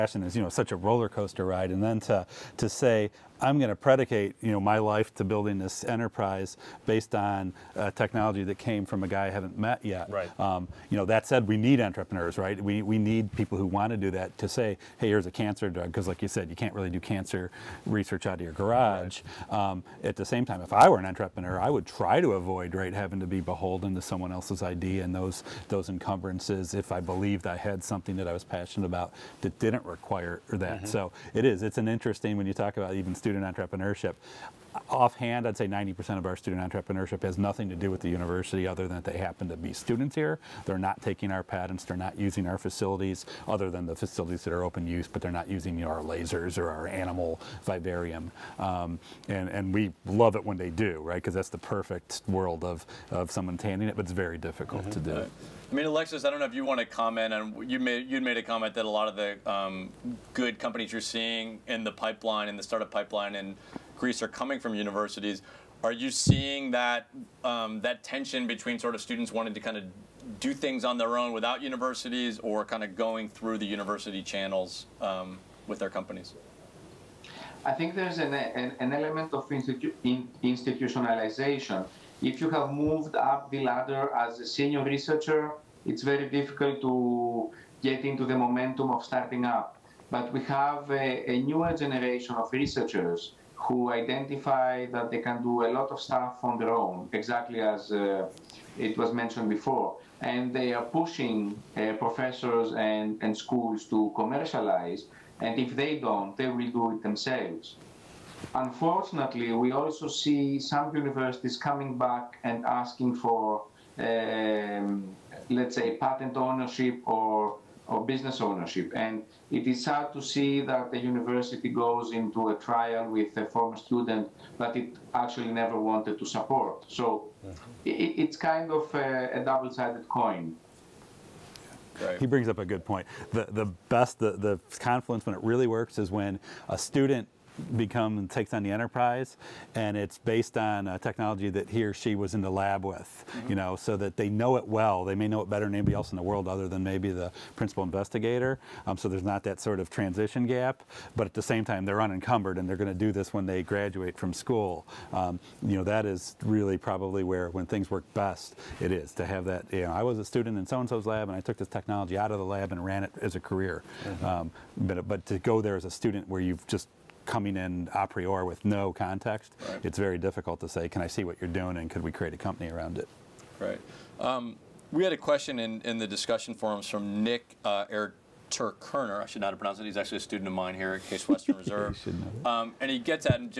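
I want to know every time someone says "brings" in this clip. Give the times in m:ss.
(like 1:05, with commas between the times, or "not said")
2:12.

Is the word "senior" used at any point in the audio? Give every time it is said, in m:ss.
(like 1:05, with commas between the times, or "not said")
1:24.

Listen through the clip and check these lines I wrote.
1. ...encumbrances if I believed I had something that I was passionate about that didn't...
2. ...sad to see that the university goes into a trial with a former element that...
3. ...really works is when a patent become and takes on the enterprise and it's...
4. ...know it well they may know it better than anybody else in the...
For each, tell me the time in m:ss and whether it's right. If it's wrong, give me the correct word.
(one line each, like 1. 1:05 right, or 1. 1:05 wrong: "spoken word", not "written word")
1. 0:25 right
2. 1:59 wrong: "student", not "element"
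3. 2:15 wrong: "student", not "patent"
4. 2:24 right.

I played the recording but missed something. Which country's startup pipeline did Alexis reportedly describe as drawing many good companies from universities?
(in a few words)
Greece.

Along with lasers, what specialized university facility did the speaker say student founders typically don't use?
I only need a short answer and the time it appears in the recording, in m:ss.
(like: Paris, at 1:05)
animal vivarium, at 0:46.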